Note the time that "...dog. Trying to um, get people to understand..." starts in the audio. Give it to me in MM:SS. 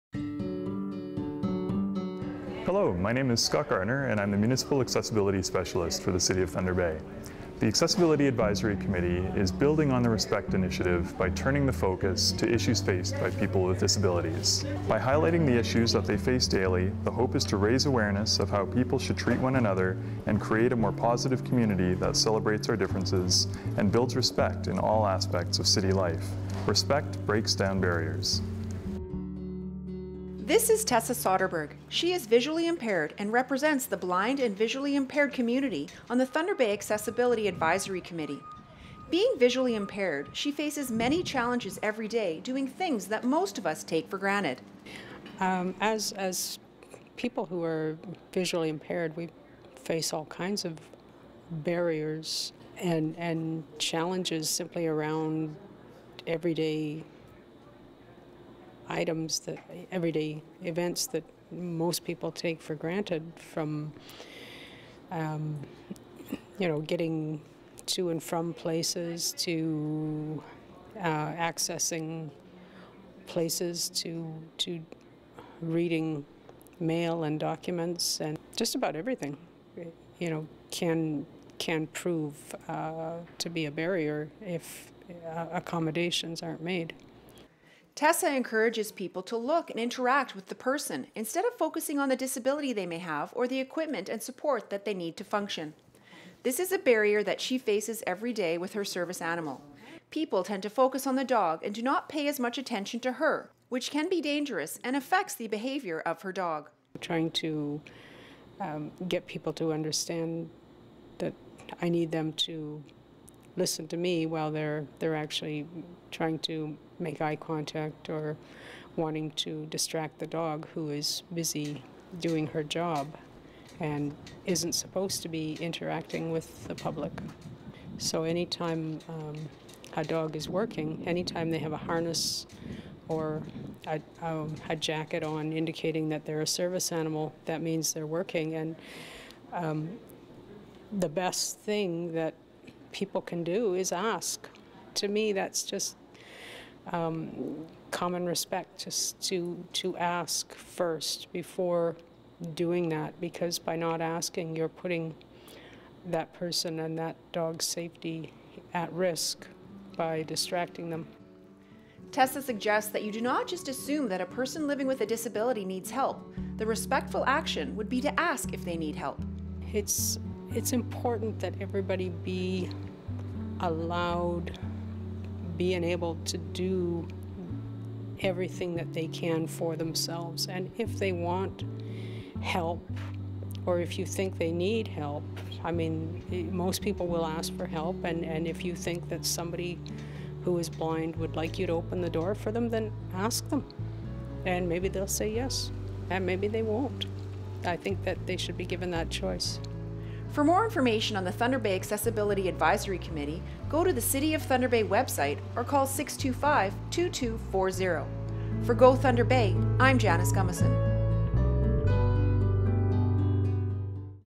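01:46.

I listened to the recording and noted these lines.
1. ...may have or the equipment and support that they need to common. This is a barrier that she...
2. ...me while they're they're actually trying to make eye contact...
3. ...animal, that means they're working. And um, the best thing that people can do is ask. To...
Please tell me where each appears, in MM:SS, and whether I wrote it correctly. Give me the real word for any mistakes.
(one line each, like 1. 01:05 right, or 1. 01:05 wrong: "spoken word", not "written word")
1. 01:32 wrong: "function", not "common"
2. 01:53 right
3. 02:16 right.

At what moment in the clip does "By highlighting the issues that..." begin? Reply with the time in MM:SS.
00:14.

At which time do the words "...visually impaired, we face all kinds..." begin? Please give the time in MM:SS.
00:48.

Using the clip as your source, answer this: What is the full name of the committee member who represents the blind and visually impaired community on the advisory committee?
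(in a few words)
Tessa Soderberg.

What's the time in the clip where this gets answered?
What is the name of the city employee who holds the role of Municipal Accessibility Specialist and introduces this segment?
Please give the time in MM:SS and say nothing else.
00:03.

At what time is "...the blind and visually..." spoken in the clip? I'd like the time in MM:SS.
00:33.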